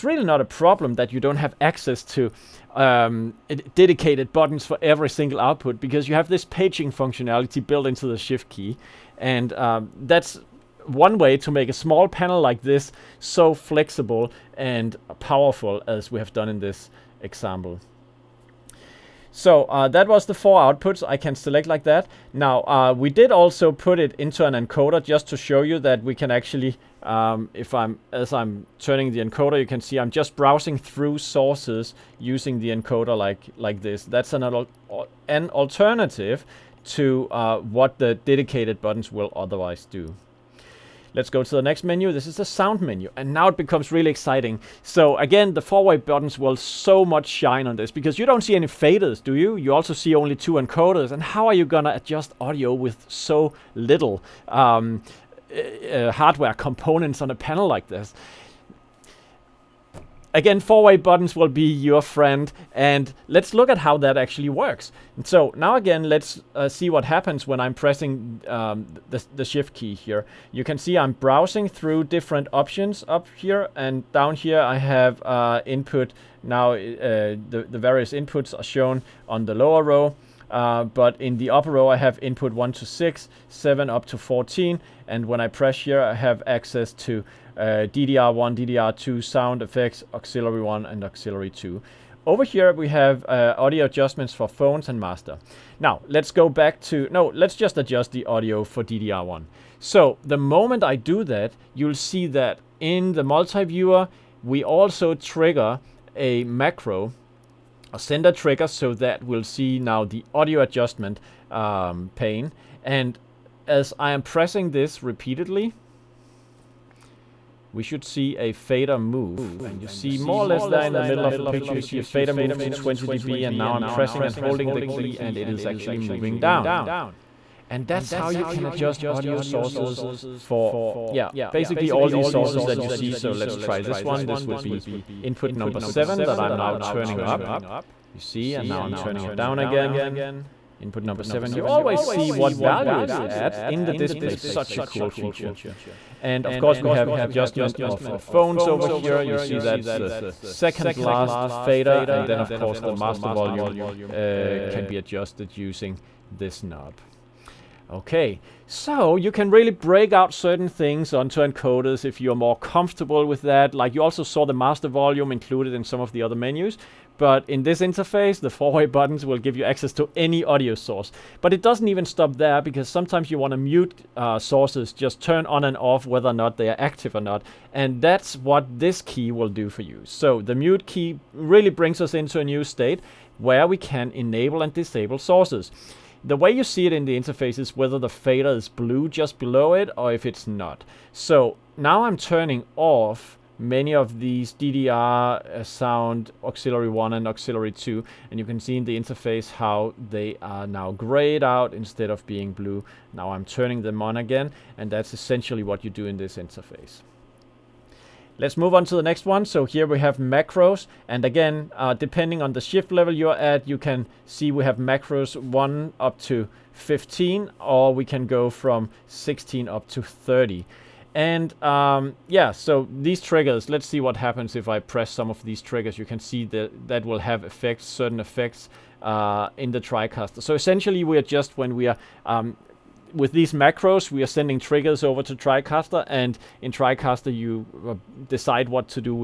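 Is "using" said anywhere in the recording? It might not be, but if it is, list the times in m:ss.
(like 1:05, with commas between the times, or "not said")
0:32, 2:35.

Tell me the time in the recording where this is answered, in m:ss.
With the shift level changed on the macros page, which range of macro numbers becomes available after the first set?
3:39.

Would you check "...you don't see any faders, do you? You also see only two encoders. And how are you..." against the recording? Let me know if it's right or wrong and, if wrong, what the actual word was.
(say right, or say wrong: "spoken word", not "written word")
right.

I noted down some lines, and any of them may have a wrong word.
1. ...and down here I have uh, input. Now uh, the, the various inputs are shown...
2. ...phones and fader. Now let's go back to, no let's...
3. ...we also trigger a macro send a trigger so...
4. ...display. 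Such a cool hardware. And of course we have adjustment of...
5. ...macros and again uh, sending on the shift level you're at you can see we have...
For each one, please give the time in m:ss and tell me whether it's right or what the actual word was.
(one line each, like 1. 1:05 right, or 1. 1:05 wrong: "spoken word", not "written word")
1. 1:13 right
2. 1:34 wrong: "master", not "fader"
3. 1:44 right
4. 2:23 wrong: "feature", not "hardware"
5. 3:30 wrong: "depending", not "sending".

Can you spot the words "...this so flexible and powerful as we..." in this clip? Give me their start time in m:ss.
0:12.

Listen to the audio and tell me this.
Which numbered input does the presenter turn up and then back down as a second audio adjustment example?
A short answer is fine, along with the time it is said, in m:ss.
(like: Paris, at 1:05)
Input 7, at 2:15.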